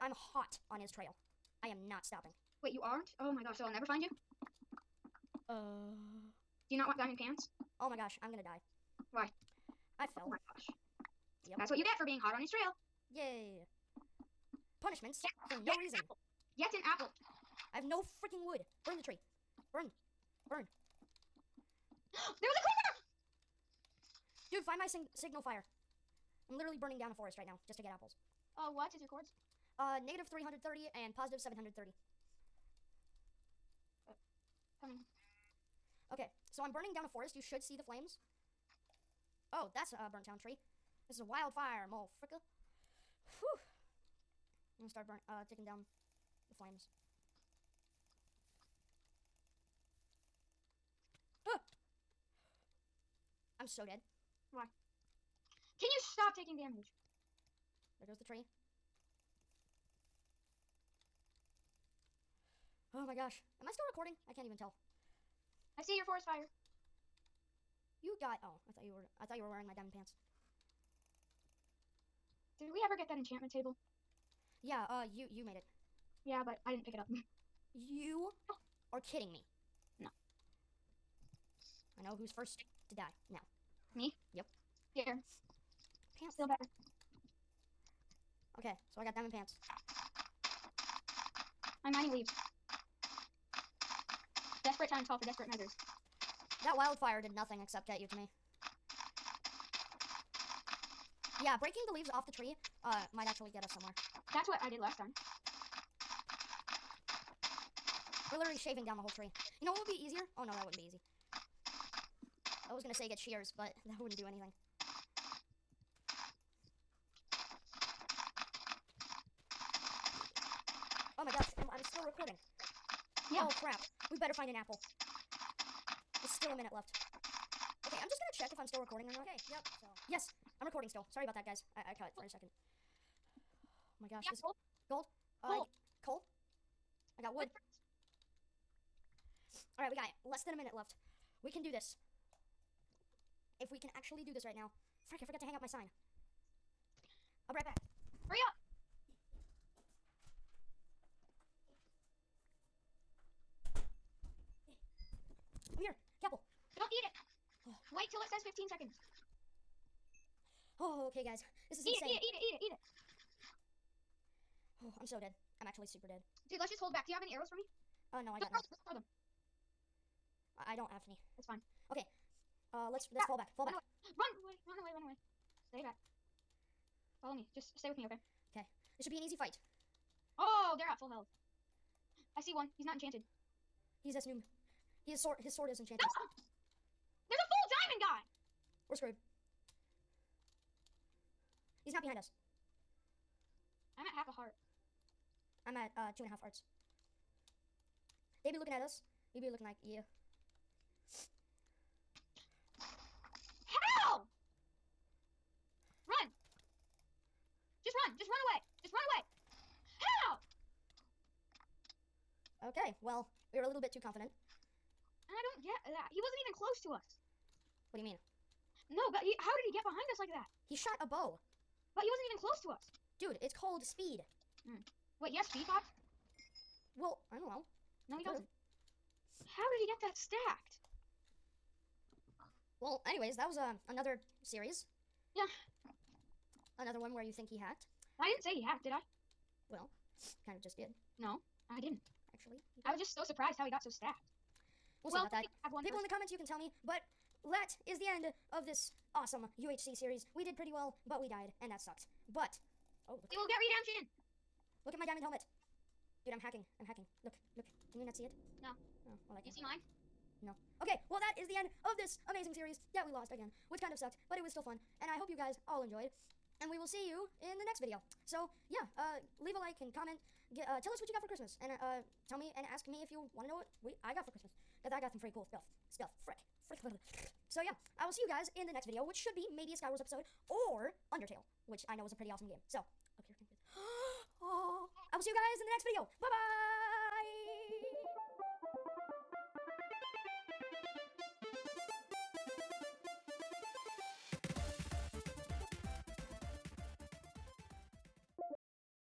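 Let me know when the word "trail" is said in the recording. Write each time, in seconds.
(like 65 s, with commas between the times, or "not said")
0 s, 12 s.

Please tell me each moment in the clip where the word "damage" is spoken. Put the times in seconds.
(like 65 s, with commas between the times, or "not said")
56 s.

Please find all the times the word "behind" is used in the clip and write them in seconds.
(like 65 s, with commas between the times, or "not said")
192 s, 219 s.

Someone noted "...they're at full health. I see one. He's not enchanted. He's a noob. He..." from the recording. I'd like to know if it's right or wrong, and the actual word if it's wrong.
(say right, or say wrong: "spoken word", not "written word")
right.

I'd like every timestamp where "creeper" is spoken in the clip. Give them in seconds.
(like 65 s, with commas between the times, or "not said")
22 s.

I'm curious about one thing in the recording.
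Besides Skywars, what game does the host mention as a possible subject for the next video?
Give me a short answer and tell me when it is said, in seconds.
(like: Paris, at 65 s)
Undertale, at 281 s.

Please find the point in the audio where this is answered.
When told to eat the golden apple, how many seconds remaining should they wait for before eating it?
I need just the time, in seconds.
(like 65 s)
158 s.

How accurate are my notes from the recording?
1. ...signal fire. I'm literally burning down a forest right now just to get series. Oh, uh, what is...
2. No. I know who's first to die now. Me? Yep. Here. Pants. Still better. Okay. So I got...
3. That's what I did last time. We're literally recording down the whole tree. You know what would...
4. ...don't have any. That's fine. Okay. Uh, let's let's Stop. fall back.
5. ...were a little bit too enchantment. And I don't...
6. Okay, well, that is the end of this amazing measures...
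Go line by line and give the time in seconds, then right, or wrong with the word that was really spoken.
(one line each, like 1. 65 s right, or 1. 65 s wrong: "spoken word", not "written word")
1. 25 s wrong: "apples", not "series"
2. 79 s right
3. 104 s wrong: "shaving", not "recording"
4. 170 s right
5. 213 s wrong: "confident", not "enchantment"
6. 260 s wrong: "series", not "measures".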